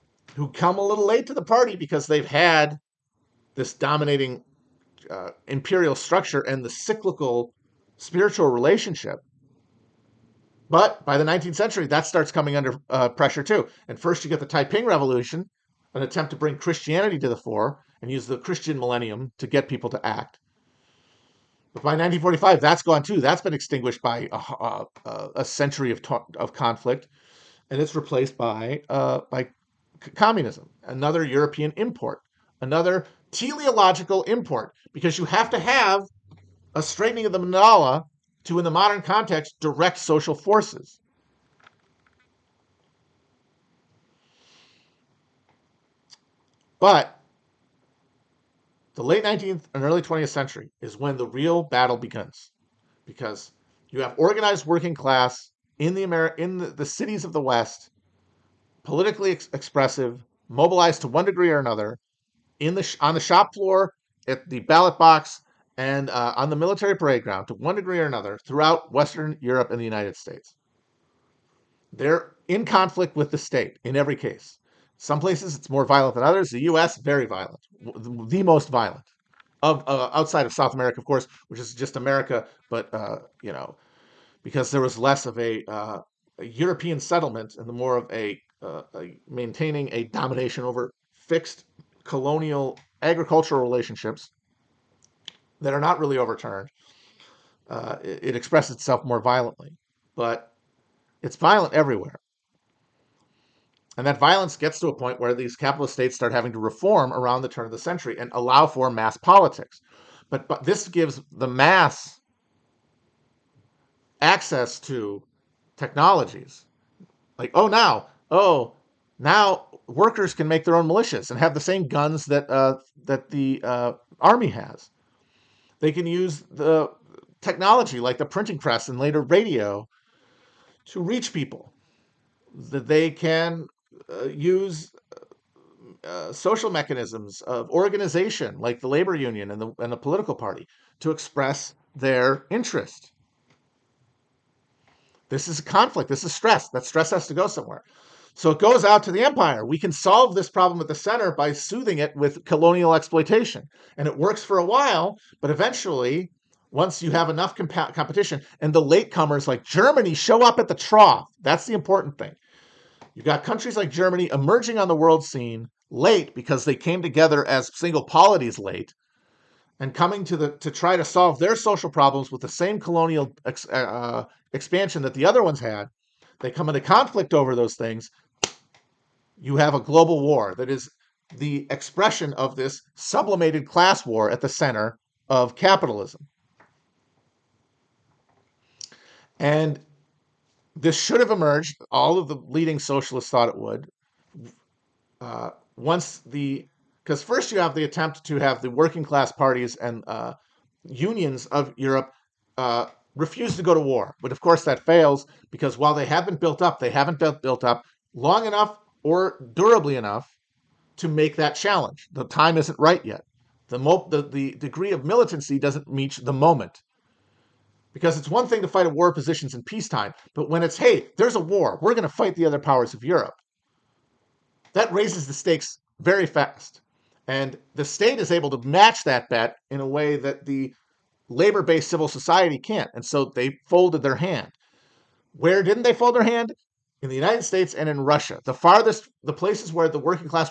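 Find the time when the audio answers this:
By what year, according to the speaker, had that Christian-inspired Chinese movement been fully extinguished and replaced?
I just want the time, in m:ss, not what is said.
0:21.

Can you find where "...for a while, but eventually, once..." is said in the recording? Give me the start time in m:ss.
2:34.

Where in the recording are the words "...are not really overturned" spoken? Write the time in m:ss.
1:35.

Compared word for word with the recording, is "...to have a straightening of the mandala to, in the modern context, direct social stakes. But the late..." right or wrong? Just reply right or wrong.
wrong.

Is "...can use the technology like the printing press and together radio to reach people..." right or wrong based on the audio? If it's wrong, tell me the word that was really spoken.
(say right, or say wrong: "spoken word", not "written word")
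wrong: "later", not "together".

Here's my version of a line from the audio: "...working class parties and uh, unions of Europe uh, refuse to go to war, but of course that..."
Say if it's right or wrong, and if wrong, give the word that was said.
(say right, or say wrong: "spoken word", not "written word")
right.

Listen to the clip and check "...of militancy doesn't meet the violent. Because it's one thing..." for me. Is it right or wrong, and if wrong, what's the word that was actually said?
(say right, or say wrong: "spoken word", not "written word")
wrong: "moment", not "violent".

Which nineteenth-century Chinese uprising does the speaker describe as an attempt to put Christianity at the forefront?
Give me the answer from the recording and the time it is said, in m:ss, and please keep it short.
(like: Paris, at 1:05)
Taiping Revolution, at 0:14.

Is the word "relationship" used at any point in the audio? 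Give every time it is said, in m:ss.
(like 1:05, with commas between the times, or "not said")
0:08, 1:33.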